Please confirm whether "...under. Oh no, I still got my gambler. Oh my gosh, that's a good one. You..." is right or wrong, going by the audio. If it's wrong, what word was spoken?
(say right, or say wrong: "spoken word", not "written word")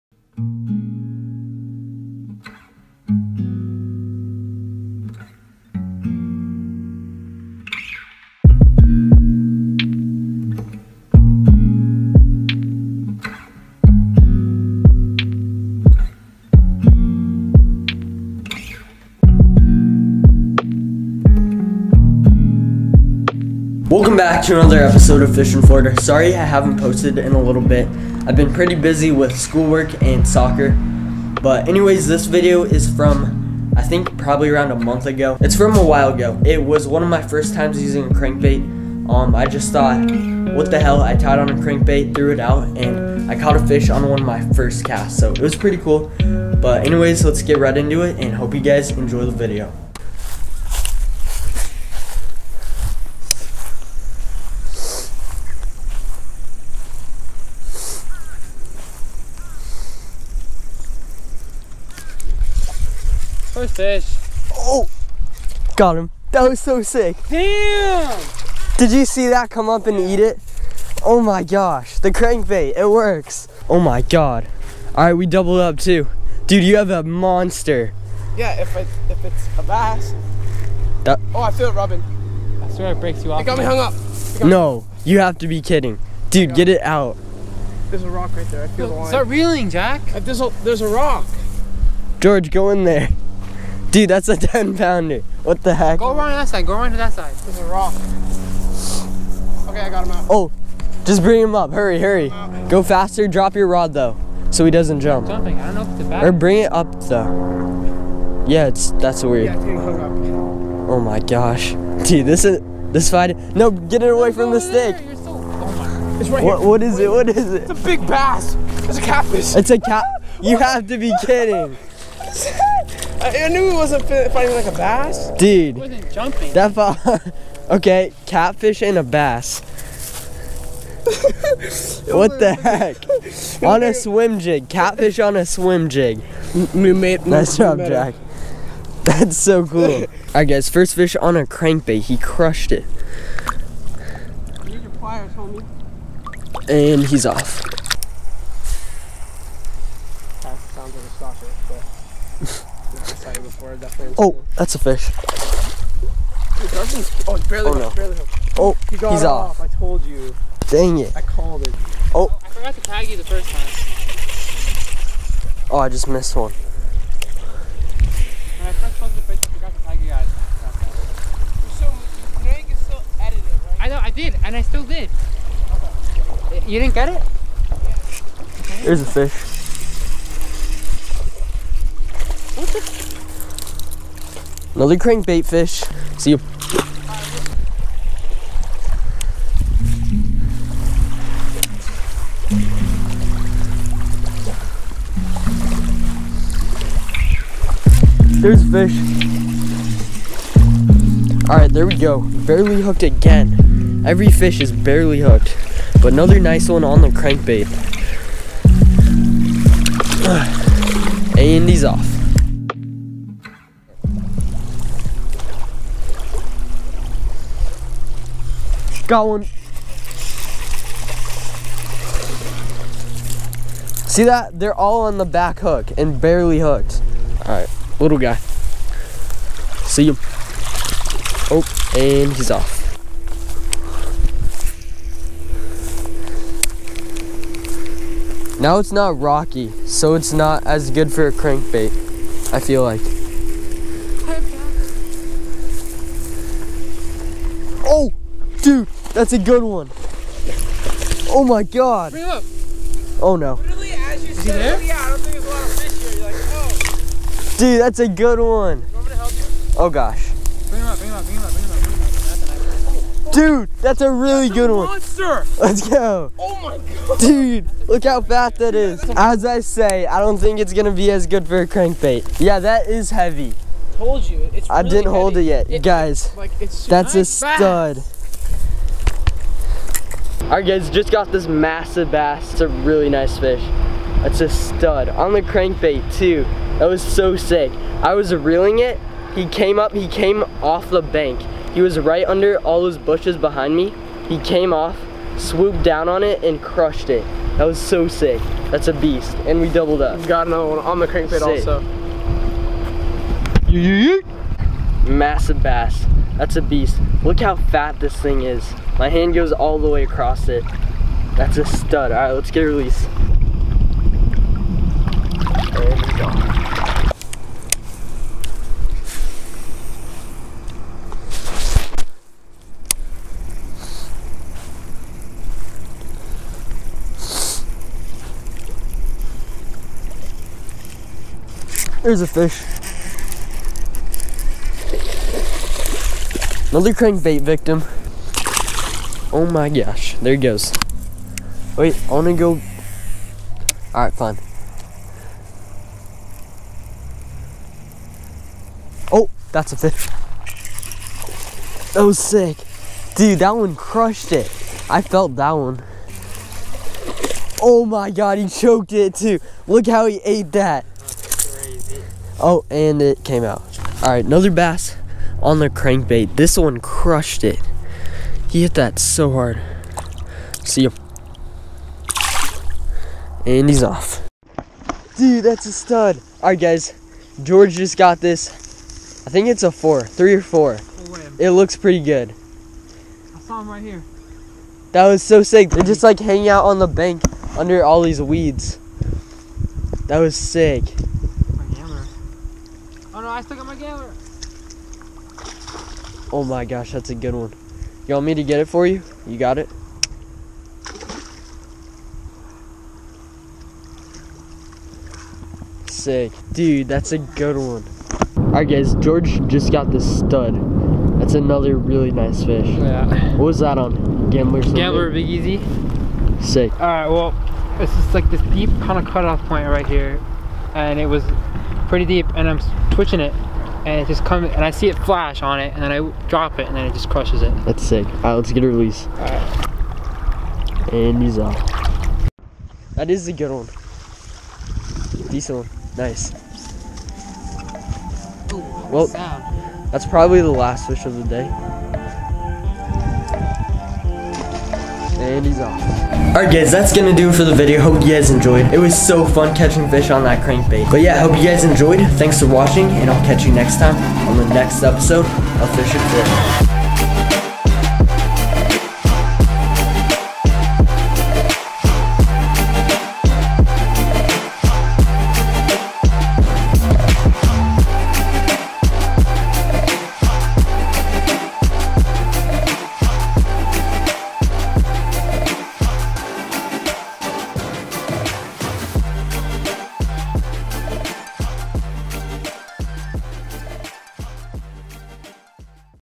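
wrong: "gambler", not "under".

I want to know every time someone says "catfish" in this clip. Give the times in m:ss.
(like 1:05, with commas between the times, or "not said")
1:59, 2:08, 2:14.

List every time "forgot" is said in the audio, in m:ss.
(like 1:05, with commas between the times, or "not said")
2:42, 2:49.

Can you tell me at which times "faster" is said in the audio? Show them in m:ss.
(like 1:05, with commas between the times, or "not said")
1:42.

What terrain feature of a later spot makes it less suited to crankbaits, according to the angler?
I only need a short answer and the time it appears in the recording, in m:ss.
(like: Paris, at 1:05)
it's not rocky, at 3:58.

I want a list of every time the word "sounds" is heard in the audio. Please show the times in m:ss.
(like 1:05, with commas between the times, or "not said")
2:30, 7:19.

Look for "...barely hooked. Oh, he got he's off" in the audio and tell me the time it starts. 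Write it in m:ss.
2:37.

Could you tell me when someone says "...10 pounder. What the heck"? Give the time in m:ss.
1:34.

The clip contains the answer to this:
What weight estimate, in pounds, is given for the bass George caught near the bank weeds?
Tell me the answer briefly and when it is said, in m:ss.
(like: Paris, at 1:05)
3 or 4, at 6:20.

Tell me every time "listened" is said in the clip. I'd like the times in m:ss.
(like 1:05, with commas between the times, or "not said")
not said.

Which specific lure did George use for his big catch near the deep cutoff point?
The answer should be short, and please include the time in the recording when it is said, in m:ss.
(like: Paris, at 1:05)
Gambler Big Easy, at 6:54.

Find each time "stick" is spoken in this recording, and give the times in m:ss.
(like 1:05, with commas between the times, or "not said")
1:54.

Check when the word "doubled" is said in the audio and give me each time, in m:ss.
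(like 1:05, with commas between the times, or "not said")
1:15, 4:59.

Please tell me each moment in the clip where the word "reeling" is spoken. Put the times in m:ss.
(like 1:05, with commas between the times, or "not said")
1:29, 4:48.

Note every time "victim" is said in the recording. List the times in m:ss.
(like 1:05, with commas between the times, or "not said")
5:37.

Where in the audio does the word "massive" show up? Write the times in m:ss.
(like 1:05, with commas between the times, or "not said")
4:41, 5:05.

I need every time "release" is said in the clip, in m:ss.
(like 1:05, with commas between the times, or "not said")
5:12, 7:08.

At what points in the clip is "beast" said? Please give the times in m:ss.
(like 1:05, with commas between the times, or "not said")
4:58, 5:06.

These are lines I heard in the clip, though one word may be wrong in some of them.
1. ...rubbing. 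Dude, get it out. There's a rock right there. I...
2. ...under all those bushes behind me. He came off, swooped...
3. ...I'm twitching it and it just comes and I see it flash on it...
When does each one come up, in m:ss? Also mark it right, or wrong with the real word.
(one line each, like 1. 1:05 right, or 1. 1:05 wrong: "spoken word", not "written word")
1. 1:25 wrong: "kidding", not "rubbing"
2. 4:52 right
3. 7:02 right.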